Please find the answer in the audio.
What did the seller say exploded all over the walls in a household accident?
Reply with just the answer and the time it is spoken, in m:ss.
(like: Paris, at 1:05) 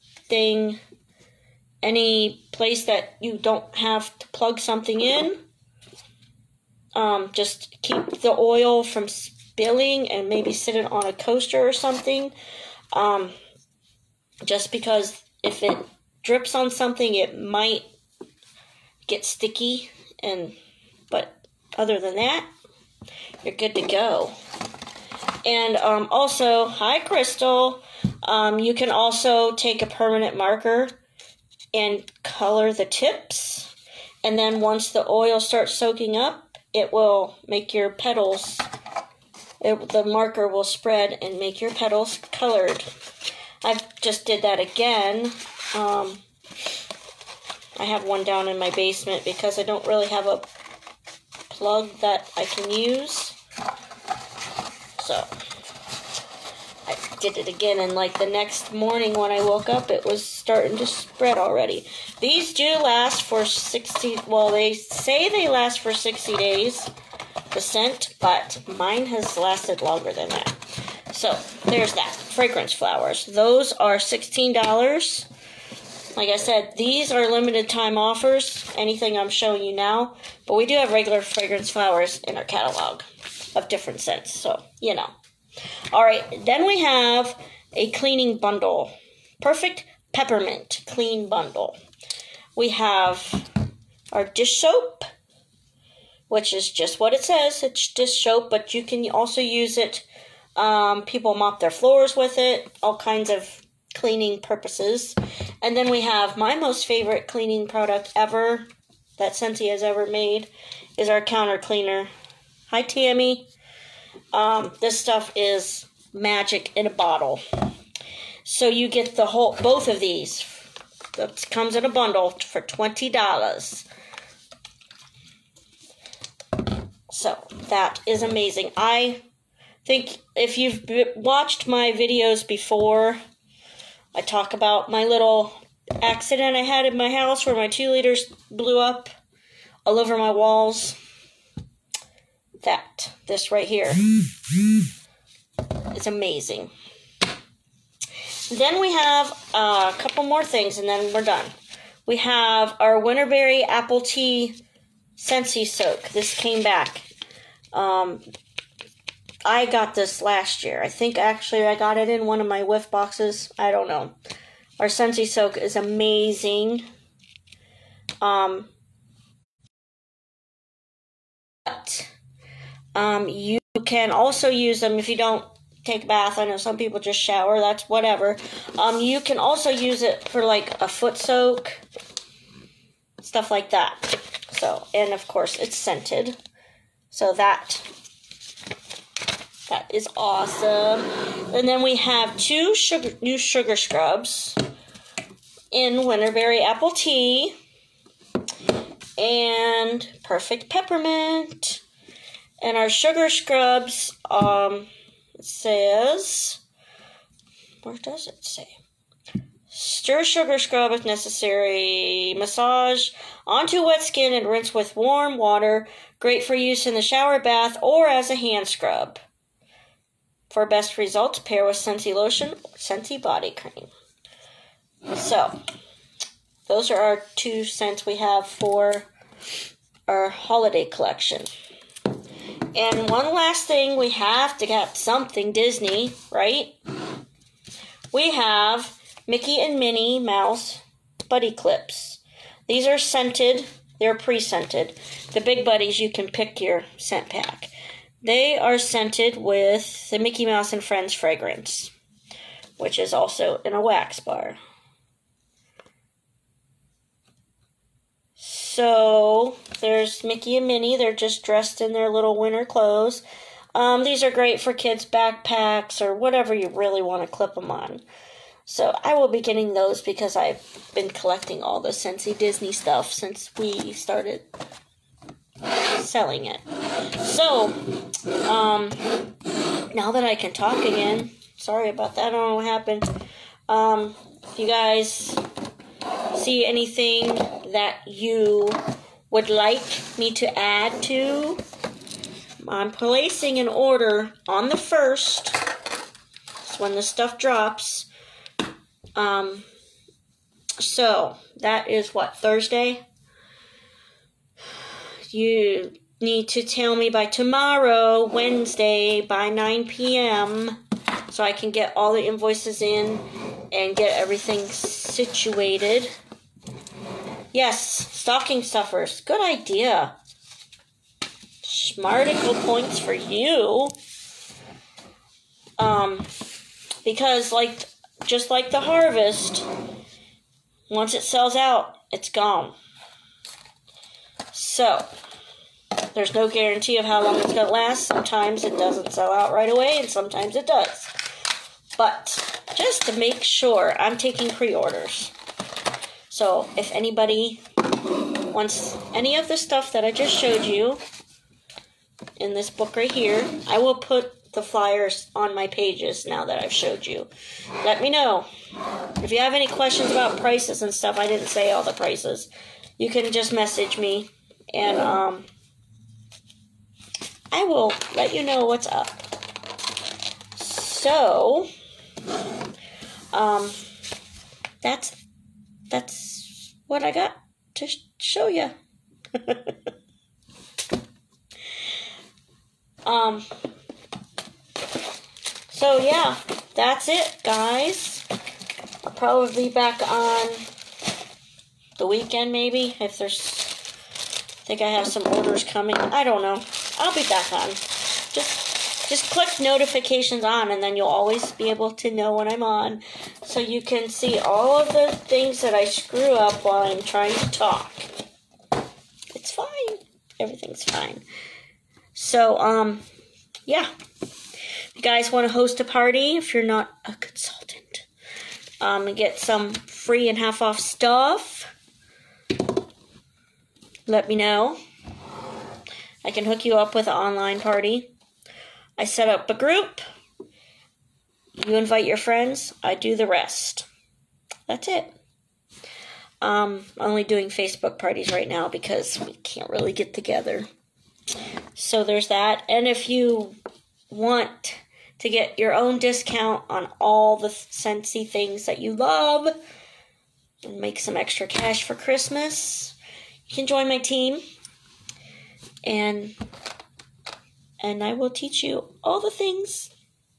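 two liters, at 2:17.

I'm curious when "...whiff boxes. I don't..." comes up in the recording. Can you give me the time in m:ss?
2:42.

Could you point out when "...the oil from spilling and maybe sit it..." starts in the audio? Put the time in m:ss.
0:08.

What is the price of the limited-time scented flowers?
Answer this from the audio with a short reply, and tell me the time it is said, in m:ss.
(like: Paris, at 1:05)
$16, at 1:13.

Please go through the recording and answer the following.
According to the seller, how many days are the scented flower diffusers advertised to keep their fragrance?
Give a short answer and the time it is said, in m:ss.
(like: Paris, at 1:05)
60, at 1:05.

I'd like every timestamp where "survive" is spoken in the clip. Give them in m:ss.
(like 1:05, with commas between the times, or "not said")
not said.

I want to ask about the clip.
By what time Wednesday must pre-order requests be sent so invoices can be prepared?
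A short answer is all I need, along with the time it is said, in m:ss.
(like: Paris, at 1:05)
9 p.m., at 5:09.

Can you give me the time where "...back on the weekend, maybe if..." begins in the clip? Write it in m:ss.
6:29.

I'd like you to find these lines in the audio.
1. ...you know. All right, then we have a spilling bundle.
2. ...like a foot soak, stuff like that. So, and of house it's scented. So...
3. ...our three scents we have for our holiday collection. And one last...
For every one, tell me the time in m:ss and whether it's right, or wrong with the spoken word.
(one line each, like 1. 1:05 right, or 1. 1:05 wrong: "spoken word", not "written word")
1. 1:24 wrong: "cleaning", not "spilling"
2. 3:00 wrong: "course", not "house"
3. 3:46 wrong: "two", not "three".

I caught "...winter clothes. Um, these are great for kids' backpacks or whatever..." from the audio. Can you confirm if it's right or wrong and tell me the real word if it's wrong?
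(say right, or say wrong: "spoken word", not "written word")
right.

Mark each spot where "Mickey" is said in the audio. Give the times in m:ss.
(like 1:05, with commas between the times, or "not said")
3:59, 4:10, 4:20.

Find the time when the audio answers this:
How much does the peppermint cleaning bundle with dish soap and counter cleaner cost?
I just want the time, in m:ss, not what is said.
2:02.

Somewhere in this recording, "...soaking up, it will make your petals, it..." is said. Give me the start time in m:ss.
0:35.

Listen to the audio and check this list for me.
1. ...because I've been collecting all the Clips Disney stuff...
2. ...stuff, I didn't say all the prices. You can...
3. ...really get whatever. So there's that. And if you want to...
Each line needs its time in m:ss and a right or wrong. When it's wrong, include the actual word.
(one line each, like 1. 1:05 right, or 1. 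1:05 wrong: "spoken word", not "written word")
1. 4:30 wrong: "Scentsy", not "Clips"
2. 6:00 right
3. 7:19 wrong: "together", not "whatever".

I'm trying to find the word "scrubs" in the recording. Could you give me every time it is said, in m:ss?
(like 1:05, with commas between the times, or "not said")
3:13, 3:23, 3:30, 3:38.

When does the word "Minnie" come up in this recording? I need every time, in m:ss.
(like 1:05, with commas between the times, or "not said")
3:59, 4:20.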